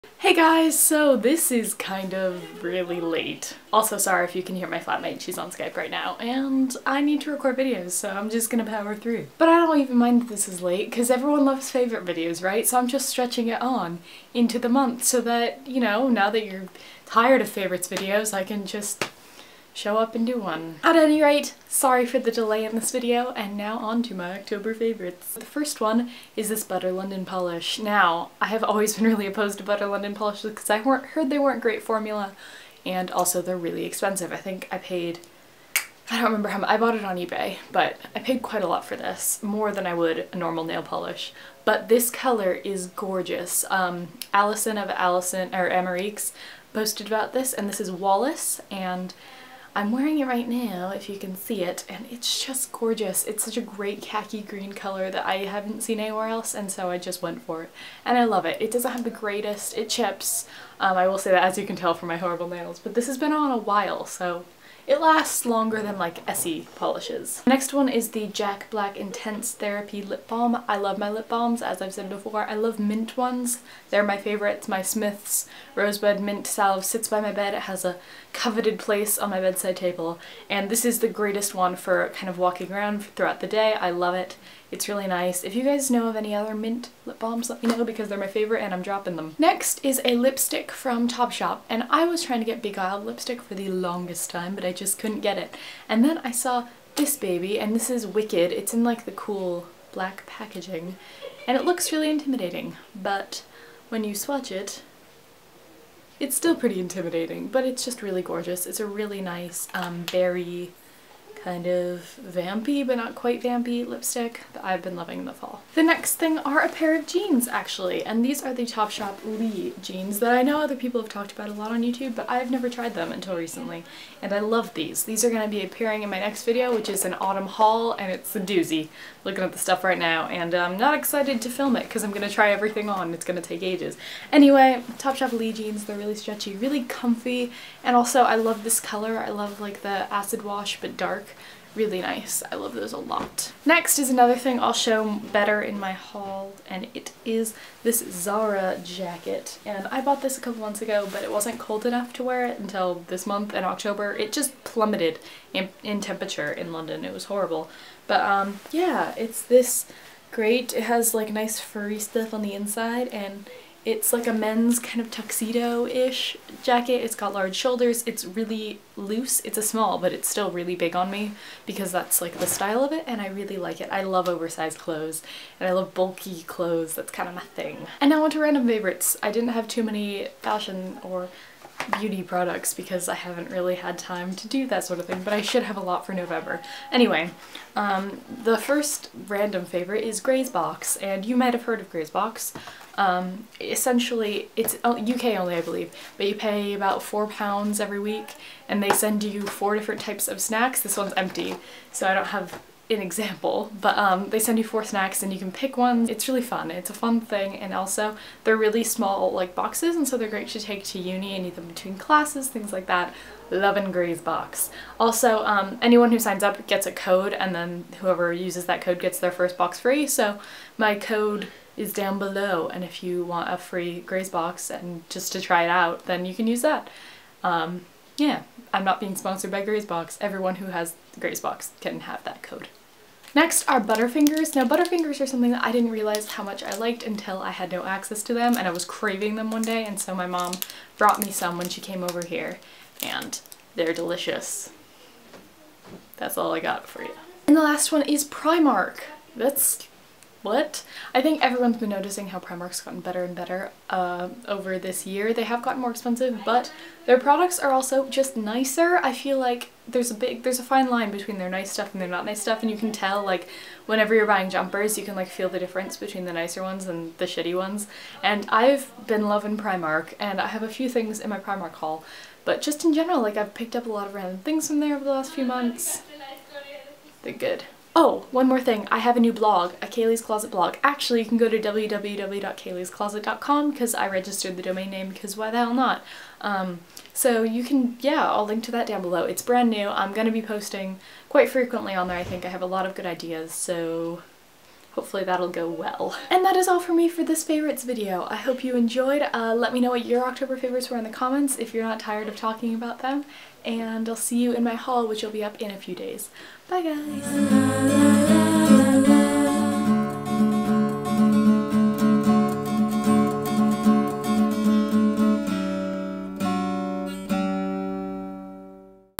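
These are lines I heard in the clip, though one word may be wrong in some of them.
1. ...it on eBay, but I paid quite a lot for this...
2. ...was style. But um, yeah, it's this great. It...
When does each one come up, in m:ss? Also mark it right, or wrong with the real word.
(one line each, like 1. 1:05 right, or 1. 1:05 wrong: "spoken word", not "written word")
1. 0:36 right
2. 2:37 wrong: "horrible", not "style".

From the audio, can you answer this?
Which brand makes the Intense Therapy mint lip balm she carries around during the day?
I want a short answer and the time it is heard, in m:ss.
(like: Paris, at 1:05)
Jack Black, at 1:08.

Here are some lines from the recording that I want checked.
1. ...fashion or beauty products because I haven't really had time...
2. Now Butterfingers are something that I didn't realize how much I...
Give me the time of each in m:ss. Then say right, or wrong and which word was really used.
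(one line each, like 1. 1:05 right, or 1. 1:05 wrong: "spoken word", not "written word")
1. 3:00 right
2. 3:54 right.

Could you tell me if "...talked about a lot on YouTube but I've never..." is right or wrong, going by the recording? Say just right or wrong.
right.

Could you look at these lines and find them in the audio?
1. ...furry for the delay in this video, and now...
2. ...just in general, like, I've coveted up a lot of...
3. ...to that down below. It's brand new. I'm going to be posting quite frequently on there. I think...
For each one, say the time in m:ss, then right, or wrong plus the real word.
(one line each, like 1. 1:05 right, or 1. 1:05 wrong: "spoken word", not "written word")
1. 0:21 wrong: "sorry", not "furry"
2. 4:32 wrong: "picked", not "coveted"
3. 4:48 right.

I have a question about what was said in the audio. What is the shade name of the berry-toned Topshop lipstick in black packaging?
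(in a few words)
Wicked.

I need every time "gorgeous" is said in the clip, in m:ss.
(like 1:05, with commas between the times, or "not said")
0:42, 0:52, 1:48.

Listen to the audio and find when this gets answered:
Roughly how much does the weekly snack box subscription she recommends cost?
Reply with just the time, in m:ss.
3:17.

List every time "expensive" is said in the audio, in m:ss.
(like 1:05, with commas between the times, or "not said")
0:33, 4:15.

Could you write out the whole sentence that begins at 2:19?
I love like the acid wash but dark really nice.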